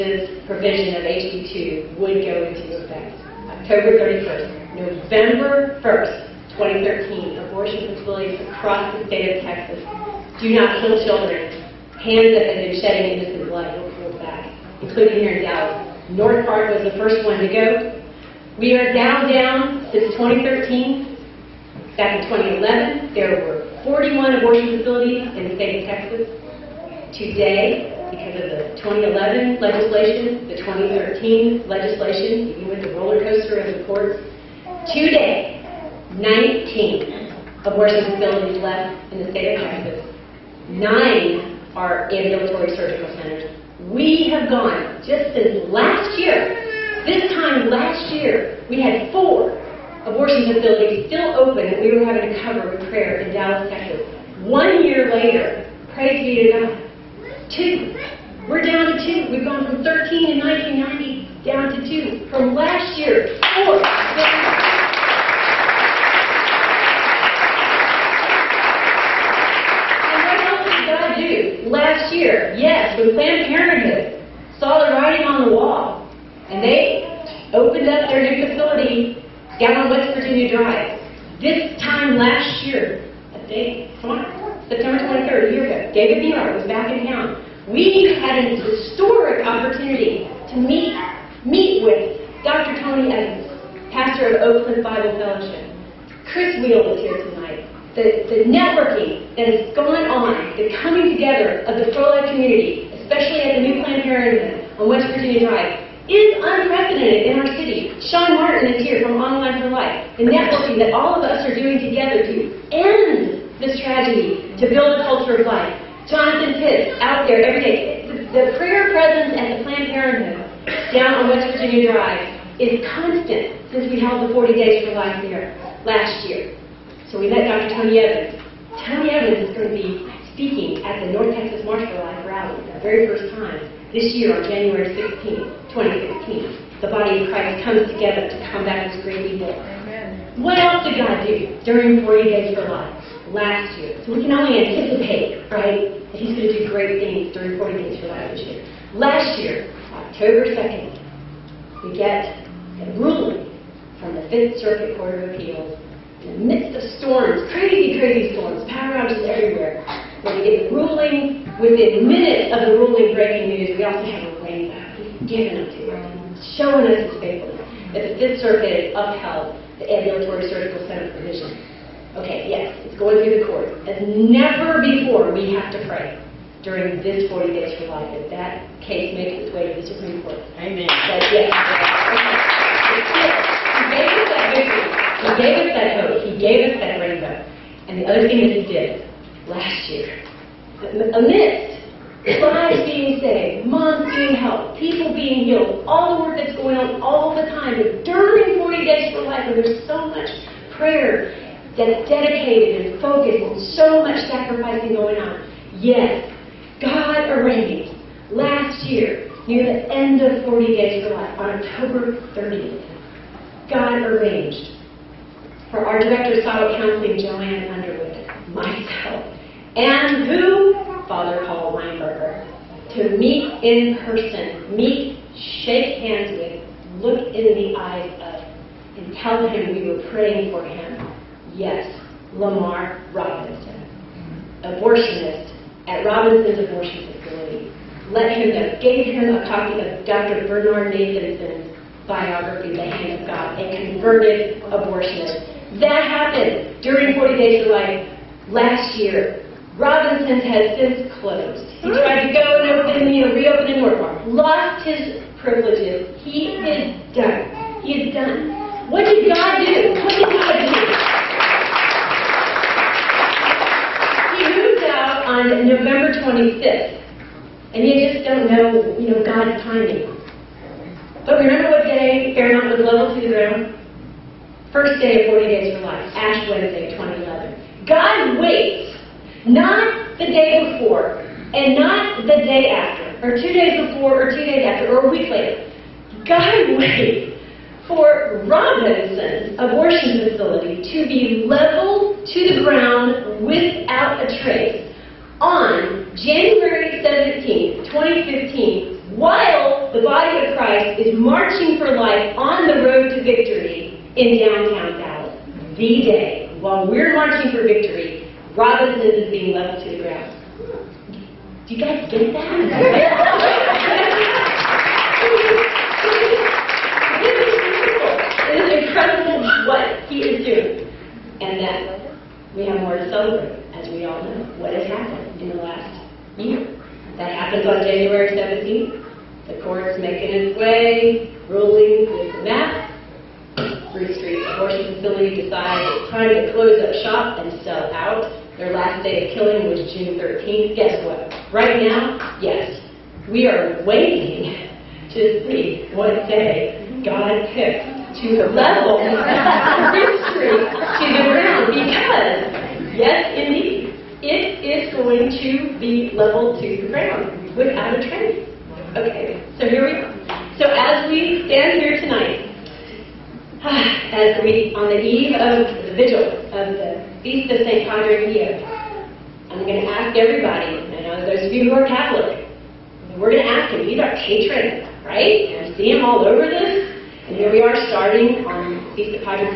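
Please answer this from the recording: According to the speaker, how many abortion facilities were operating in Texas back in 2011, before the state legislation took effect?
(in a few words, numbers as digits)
41.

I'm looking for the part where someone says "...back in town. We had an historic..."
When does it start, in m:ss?
1:26.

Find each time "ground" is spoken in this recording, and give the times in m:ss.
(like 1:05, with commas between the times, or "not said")
5:10, 5:51, 5:56.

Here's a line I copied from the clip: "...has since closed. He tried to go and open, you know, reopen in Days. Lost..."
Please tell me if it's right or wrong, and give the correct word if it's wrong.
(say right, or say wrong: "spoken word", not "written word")
wrong: "Mortimer", not "Days".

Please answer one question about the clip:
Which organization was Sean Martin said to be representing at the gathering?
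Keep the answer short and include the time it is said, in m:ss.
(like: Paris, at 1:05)
Online for Life, at 1:49.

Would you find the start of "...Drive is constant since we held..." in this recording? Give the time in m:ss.
2:01.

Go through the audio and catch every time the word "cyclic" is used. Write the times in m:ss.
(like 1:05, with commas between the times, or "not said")
not said.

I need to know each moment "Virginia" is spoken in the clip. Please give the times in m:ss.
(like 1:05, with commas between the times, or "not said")
1:20, 1:45, 2:01.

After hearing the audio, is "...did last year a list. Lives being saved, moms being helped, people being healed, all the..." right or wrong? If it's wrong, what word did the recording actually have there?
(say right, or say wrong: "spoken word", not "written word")
right.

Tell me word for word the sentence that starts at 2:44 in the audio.
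He's given us showing us his faithfulness.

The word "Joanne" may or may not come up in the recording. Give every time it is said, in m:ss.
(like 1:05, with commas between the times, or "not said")
3:37.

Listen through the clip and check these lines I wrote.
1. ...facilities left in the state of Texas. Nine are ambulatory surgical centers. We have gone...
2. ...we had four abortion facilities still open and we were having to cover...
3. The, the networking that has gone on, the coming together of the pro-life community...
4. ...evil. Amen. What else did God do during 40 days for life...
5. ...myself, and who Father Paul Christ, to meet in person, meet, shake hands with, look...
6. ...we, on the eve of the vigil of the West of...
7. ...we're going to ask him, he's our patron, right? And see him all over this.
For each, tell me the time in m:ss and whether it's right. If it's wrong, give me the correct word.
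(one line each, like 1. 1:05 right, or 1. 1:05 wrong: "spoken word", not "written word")
1. 0:38 right
2. 0:48 right
3. 1:37 right
4. 2:19 right
5. 3:38 wrong: "Weinberger", not "Christ"
6. 6:04 wrong: "Feast", not "West"
7. 6:13 right.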